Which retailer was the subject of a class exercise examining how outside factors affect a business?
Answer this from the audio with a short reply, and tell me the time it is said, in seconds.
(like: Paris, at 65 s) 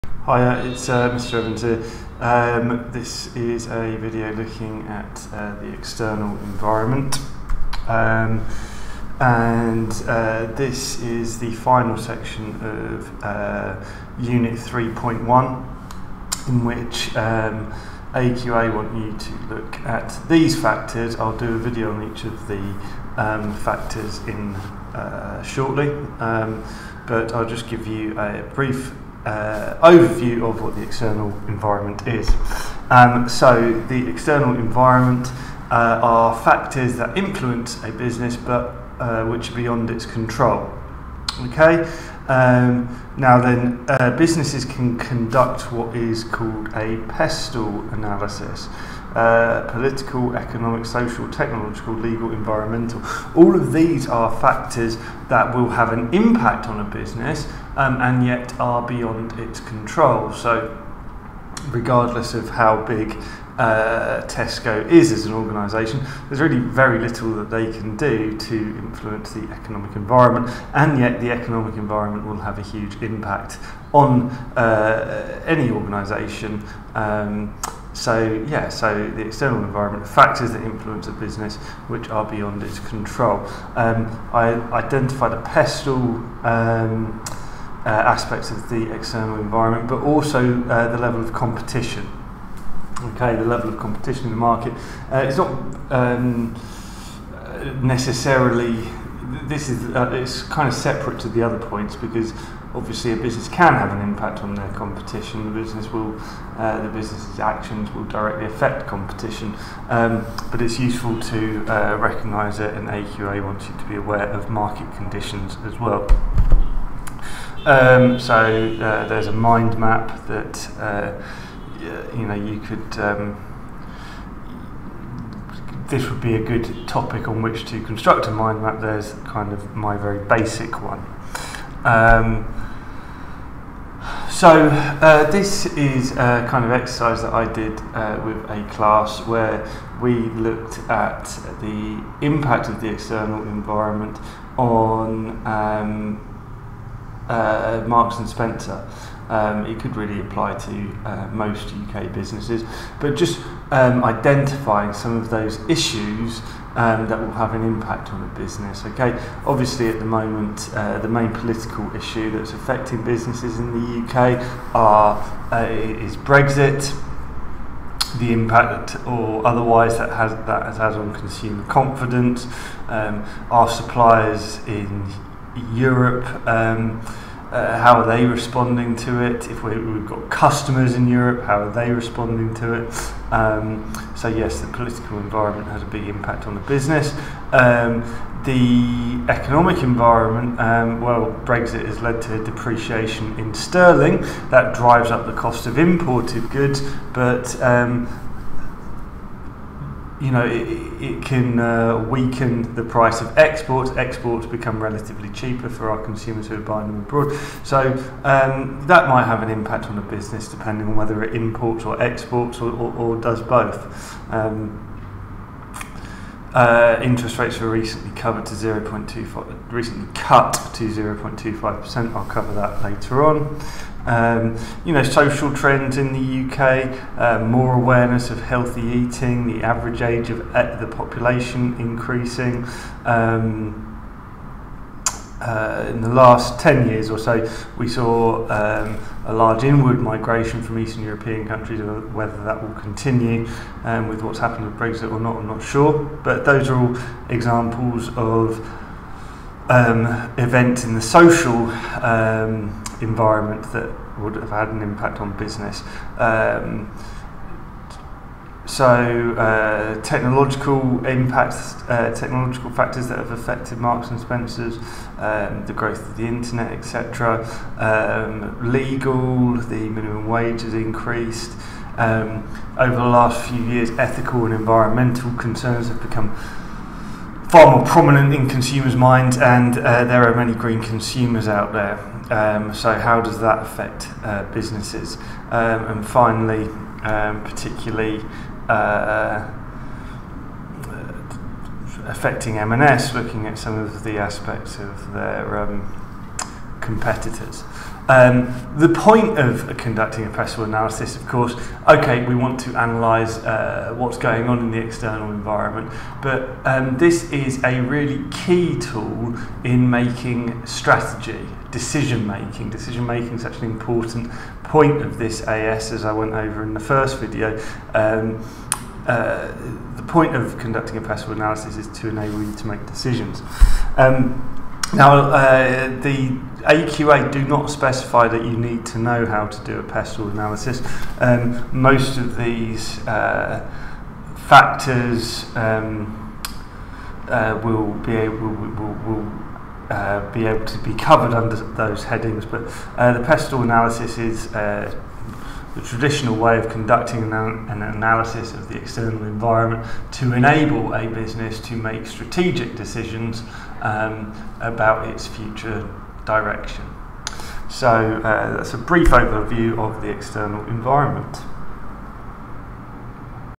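Marks and Spencer, at 147 s.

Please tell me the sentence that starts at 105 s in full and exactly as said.
The business will, uh, the business's actions will directly affect competition.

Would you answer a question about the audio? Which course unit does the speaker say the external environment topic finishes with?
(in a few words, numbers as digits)
3.1.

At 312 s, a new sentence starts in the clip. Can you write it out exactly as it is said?
Decision making is such an important point of this AS, as I went over in the first video.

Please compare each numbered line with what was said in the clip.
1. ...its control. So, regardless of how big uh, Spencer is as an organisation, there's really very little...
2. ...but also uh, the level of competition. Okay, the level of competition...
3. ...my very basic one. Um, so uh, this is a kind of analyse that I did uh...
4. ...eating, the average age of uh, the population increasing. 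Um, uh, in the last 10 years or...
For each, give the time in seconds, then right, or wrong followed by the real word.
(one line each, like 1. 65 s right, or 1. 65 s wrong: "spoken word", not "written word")
1. 59 s wrong: "Tesco", not "Spencer"
2. 89 s right
3. 129 s wrong: "exercise", not "analyse"
4. 228 s right.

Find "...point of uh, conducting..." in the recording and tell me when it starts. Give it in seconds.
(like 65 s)
298 s.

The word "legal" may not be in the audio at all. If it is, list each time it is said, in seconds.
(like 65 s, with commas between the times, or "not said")
51 s, 268 s.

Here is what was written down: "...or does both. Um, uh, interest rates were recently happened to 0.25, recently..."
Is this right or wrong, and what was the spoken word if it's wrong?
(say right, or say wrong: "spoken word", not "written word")
wrong: "covered", not "happened".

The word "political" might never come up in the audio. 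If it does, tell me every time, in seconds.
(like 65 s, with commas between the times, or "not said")
49 s, 161 s, 184 s.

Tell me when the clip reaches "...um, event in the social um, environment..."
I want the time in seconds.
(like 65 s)
249 s.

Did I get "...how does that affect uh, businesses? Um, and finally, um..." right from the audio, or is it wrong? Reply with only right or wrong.
right.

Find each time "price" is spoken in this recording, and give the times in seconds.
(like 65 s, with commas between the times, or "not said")
202 s.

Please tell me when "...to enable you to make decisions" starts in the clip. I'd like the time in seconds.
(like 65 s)
321 s.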